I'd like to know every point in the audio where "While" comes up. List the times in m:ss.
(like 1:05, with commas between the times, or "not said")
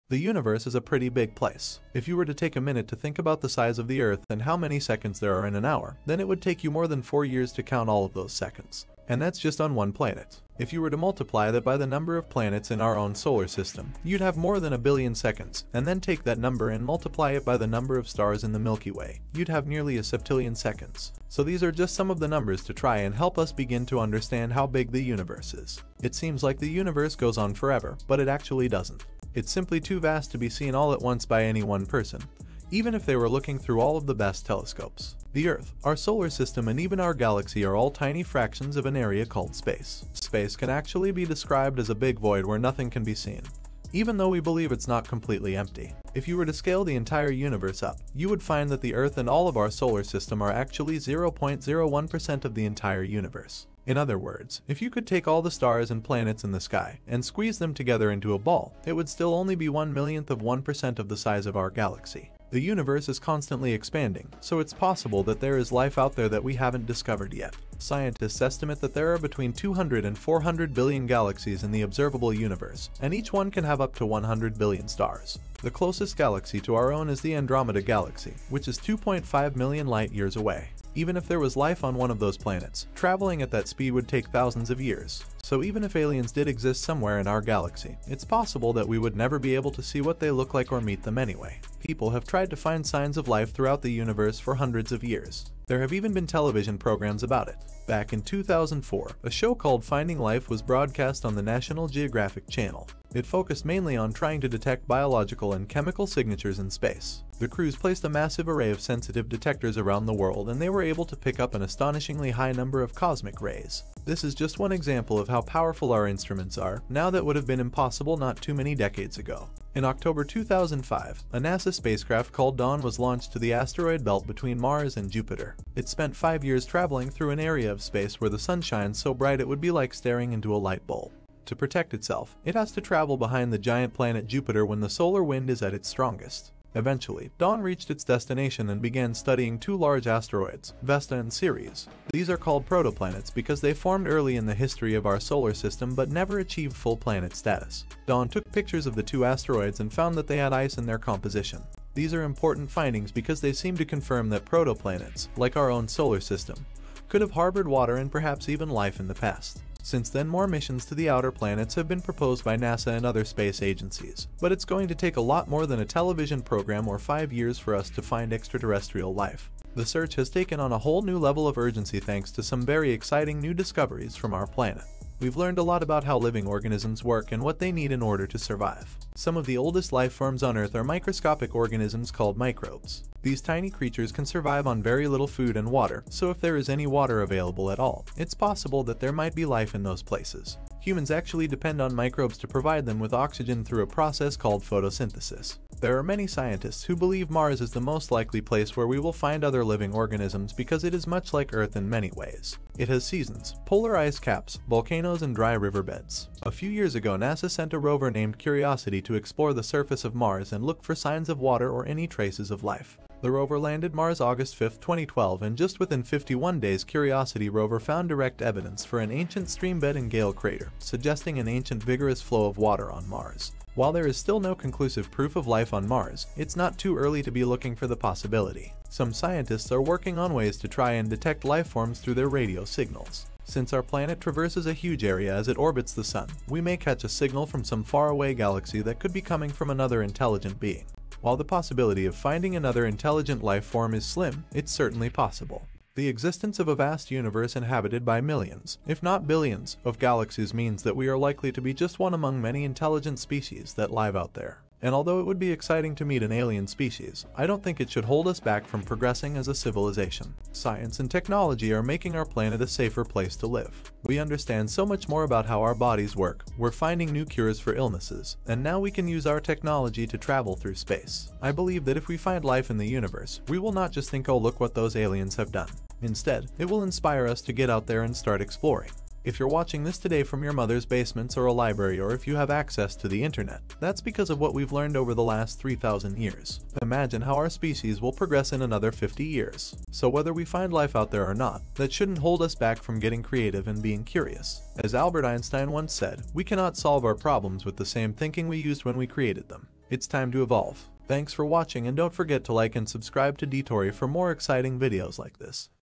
3:43, 4:01.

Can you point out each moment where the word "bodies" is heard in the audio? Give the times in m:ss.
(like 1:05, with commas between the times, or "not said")
4:25.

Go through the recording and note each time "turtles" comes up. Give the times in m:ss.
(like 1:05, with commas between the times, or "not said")
not said.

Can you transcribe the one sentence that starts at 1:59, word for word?
In October 2005, a NASA spacecraft called Dawn was launched to the asteroid belt between Mars and Jupiter.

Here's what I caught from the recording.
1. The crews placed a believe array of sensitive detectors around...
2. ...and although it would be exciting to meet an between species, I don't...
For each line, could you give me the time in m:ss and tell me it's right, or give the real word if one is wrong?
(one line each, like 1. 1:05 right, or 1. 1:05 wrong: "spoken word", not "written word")
1. 1:47 wrong: "massive", not "believe"
2. 4:14 wrong: "alien", not "between".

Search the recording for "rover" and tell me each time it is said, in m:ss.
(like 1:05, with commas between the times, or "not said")
3:27, 3:33, 3:37.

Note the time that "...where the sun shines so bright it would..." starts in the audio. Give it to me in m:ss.
2:08.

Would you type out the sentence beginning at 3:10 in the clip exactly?
Humans actually depend on microbes to provide them with oxygen through a process called photosynthesis.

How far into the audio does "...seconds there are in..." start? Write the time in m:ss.
0:04.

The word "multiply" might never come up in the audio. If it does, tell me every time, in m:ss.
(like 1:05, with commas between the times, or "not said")
0:10, 0:16.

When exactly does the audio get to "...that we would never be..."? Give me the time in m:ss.
1:28.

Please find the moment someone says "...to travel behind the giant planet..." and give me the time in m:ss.
2:12.